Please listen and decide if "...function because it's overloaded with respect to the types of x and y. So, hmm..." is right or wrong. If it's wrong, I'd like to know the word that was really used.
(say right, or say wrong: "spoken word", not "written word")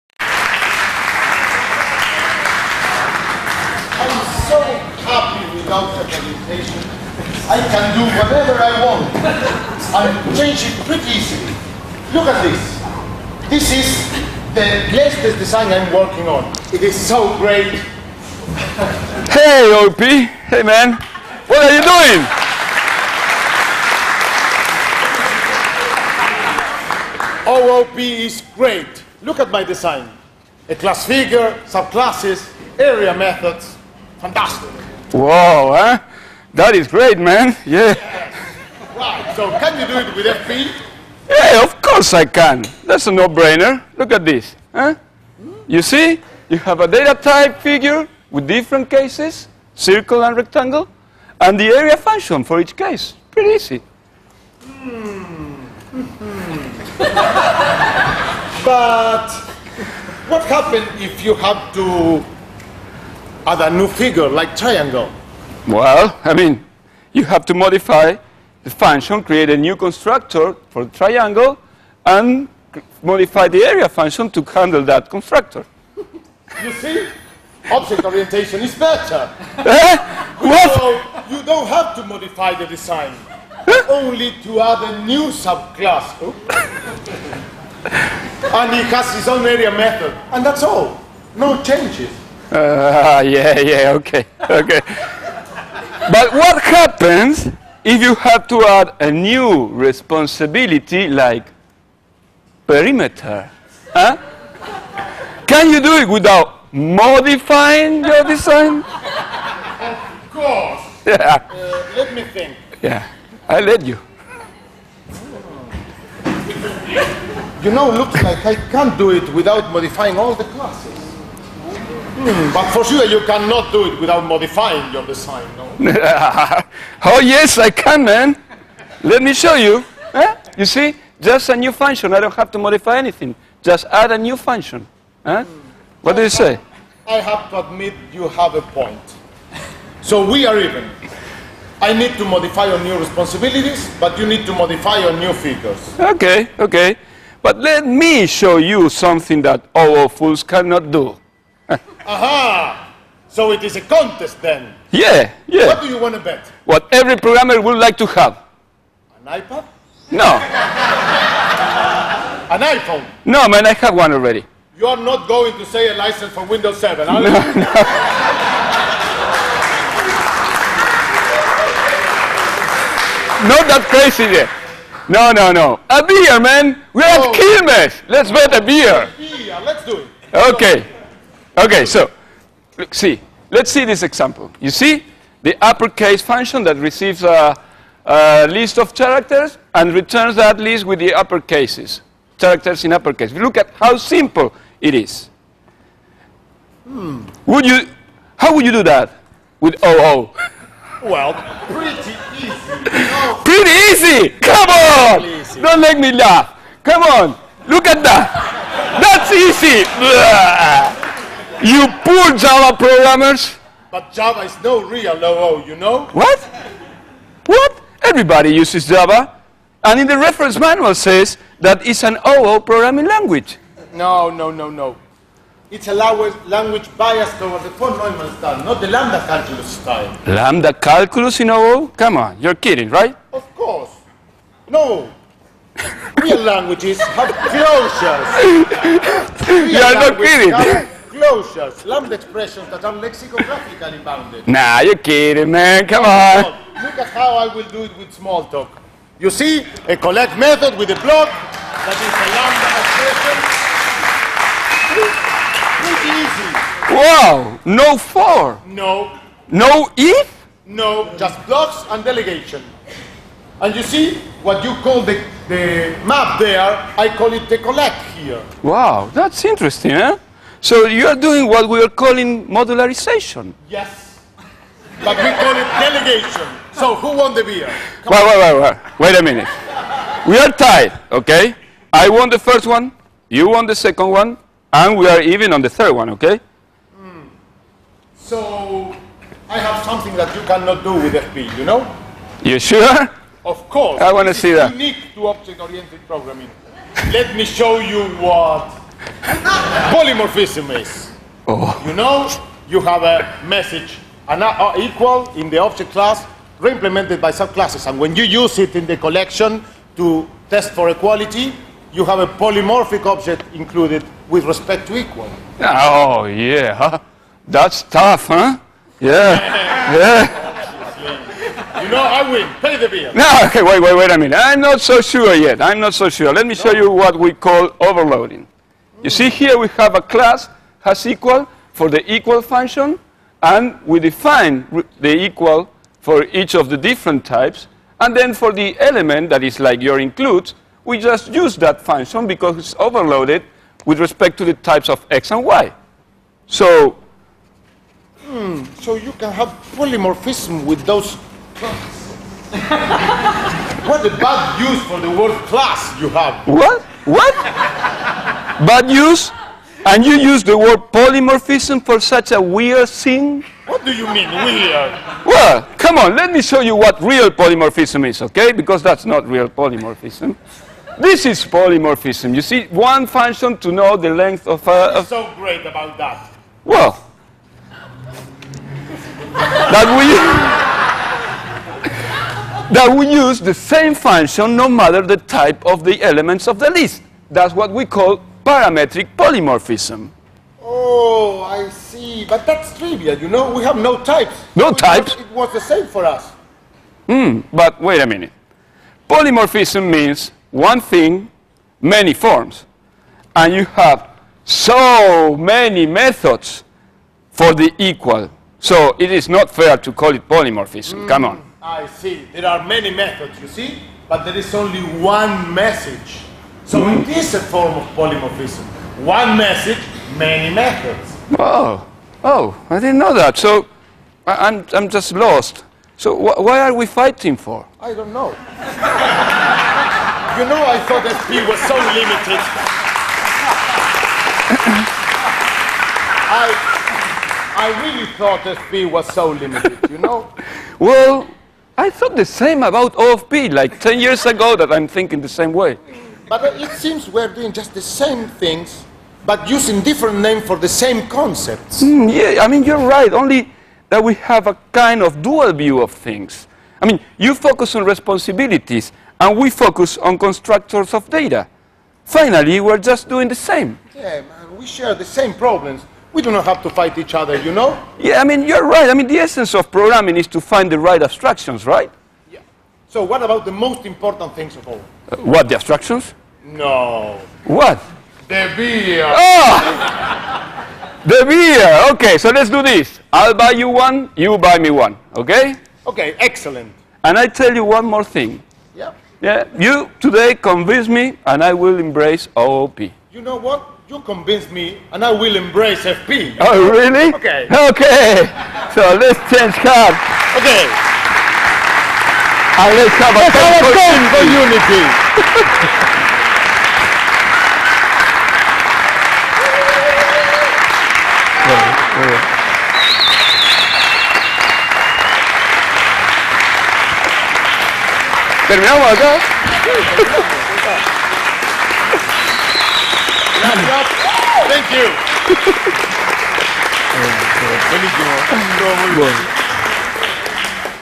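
right.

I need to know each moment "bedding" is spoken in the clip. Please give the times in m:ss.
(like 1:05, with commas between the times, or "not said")
not said.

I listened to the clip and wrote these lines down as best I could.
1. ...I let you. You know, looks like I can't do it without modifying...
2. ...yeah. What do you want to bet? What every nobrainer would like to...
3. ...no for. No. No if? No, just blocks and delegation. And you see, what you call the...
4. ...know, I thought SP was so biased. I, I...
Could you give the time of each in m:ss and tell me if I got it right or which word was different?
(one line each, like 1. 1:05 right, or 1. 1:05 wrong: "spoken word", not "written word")
1. 1:53 right
2. 2:35 wrong: "programmer", not "nobrainer"
3. 4:17 right
4. 7:10 wrong: "limited", not "biased".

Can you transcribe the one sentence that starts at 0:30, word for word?
A class figure, subclasses, area methods, Fantastic.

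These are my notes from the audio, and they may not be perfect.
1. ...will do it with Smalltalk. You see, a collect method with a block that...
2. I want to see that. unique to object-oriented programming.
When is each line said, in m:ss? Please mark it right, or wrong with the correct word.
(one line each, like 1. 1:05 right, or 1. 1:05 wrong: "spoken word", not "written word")
1. 4:07 right
2. 4:53 right.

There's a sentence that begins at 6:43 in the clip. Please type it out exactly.
And you have so many methods for the equal.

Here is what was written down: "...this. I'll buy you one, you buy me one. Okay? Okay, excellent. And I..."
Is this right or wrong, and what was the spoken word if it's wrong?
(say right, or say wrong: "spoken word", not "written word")
right.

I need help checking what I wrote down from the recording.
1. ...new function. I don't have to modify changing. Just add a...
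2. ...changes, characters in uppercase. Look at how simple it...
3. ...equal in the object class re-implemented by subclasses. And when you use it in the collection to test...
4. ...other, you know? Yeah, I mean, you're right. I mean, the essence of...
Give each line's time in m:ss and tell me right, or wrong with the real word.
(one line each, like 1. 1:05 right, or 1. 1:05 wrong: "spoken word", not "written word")
1. 2:11 wrong: "anything", not "changing"
2. 3:11 wrong: "uppercases", not "changes"
3. 5:04 right
4. 7:47 right.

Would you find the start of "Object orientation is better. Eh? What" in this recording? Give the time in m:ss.
1:17.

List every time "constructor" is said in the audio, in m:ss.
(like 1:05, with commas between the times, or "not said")
1:09, 1:15, 7:40.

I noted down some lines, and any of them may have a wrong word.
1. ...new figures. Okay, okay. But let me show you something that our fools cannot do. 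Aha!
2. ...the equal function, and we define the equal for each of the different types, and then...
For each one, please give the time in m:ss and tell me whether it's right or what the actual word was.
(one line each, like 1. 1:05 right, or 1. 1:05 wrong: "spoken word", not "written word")
1. 2:25 right
2. 5:31 right.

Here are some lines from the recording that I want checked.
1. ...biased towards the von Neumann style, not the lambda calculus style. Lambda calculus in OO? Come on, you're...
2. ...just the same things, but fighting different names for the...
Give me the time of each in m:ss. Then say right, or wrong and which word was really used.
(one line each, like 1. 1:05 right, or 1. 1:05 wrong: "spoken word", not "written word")
1. 3:46 right
2. 7:27 wrong: "using", not "fighting".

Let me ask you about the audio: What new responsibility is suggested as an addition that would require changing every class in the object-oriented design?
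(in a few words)
perimeter.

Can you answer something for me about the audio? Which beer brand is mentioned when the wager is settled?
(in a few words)
Quilmes.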